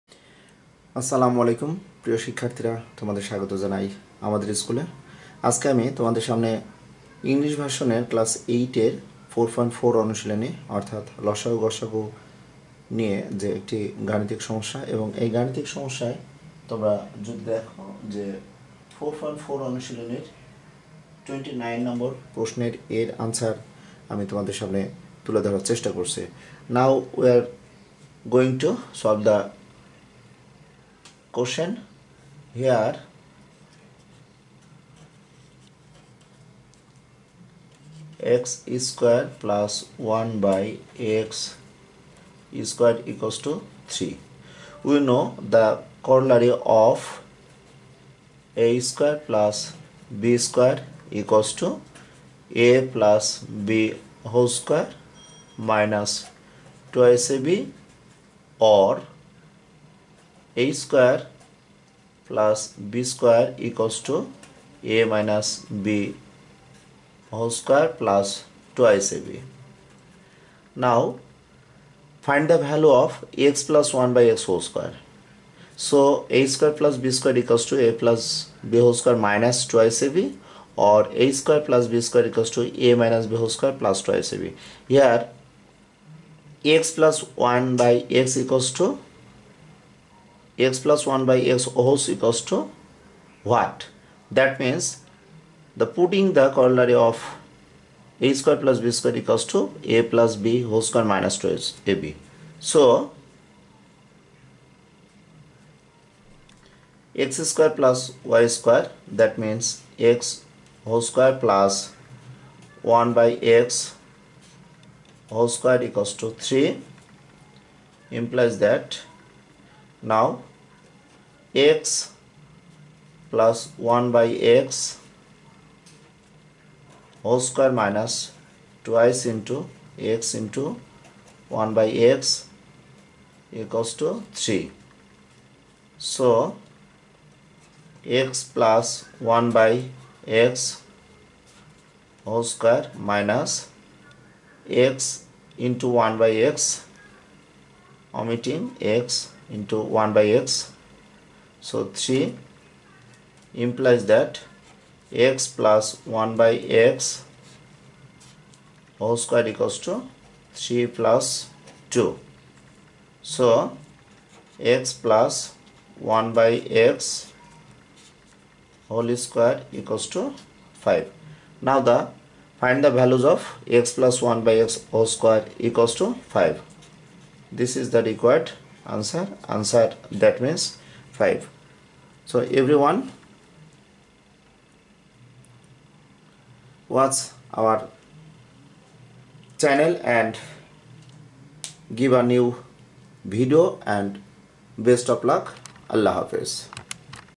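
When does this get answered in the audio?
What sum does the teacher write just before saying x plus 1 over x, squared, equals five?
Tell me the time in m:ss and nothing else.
2:40.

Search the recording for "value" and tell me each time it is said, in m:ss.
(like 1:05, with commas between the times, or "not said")
1:12, 2:52.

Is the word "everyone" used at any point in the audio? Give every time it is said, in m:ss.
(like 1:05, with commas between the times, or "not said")
3:02.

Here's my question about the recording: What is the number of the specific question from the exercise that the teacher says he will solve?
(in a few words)
29.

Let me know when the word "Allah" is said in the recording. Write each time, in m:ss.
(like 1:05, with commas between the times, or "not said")
3:15.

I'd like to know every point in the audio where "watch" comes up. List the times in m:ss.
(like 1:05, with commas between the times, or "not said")
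3:06.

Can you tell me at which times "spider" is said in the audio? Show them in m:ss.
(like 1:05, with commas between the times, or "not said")
not said.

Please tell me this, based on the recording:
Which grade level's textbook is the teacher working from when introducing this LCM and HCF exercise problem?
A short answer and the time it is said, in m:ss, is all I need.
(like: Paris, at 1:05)
Class 8, at 0:08.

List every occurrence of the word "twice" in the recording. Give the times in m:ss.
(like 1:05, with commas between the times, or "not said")
0:56, 1:08, 1:19, 1:24, 2:08.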